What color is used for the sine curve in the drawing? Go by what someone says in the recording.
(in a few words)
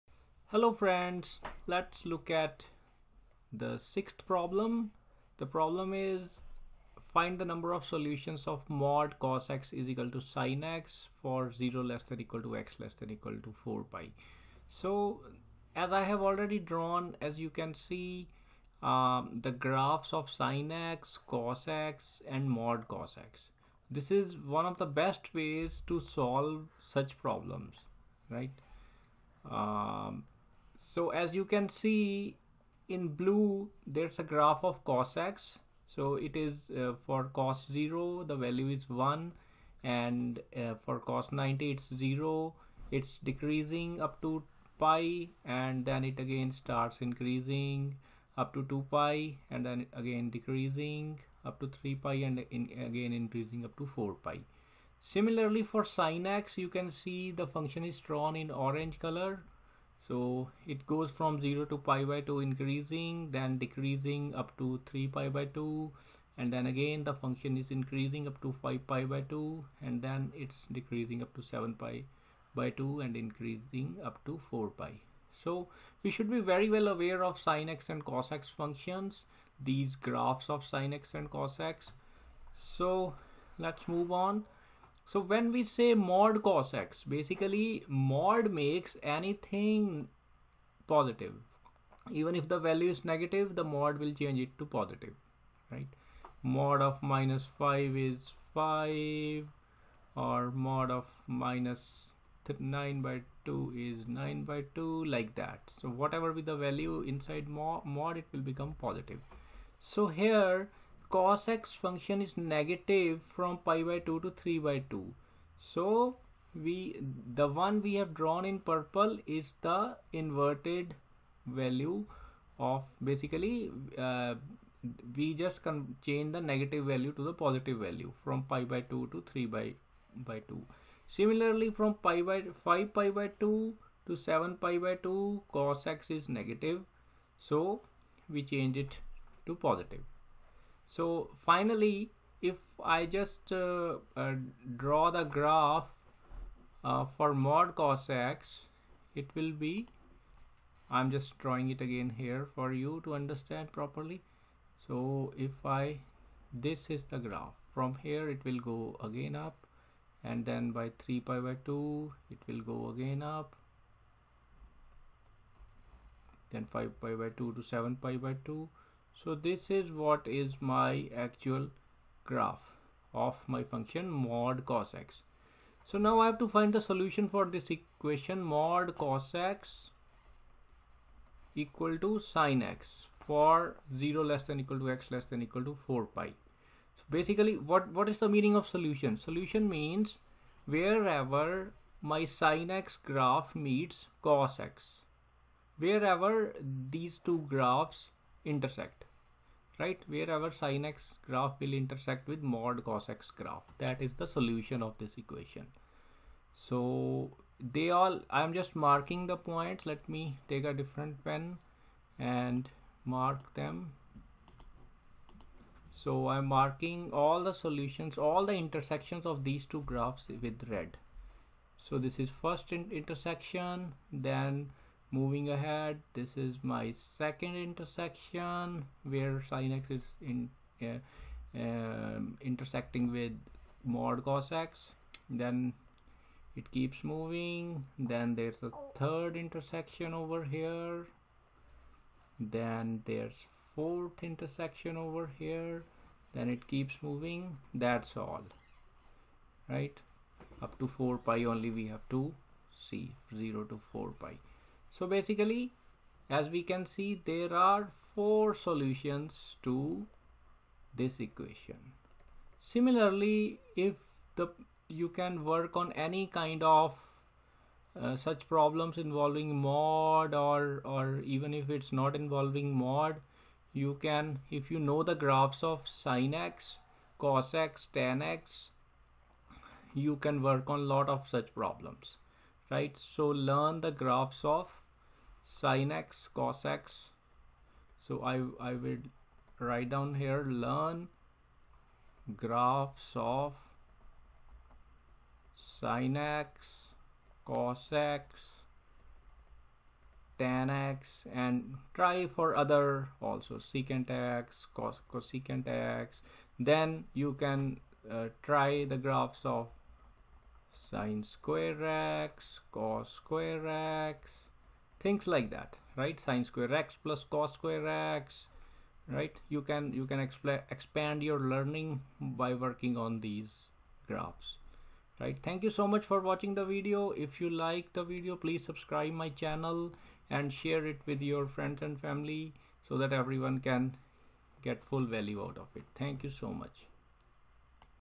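orange.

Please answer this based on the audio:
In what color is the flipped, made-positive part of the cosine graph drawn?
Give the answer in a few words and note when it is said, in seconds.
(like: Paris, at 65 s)
purple, at 118 s.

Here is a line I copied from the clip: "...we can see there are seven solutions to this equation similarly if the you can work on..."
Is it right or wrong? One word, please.
wrong.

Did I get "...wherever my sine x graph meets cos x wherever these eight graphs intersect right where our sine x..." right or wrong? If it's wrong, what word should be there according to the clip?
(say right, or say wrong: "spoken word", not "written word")
wrong: "two", not "eight".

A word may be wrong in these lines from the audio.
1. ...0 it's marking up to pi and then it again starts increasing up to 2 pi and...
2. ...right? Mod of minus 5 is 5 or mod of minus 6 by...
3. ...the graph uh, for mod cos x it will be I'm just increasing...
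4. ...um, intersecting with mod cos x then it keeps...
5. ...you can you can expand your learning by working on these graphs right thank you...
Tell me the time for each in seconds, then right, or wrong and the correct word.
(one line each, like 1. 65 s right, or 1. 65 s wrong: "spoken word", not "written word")
1. 41 s wrong: "decreasing", not "marking"
2. 95 s wrong: "9", not "6"
3. 145 s wrong: "drawing", not "increasing"
4. 231 s right
5. 319 s right.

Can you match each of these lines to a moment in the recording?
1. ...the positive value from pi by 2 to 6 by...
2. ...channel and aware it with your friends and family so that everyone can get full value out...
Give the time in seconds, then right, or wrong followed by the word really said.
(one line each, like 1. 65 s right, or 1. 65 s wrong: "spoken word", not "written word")
1. 127 s wrong: "3", not "6"
2. 329 s wrong: "share", not "aware".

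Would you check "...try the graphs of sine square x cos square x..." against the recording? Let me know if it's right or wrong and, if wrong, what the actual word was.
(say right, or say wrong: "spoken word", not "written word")
right.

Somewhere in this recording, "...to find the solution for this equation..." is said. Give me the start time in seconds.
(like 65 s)
176 s.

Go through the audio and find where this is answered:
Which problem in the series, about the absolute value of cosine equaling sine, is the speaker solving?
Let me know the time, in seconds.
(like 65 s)
3 s.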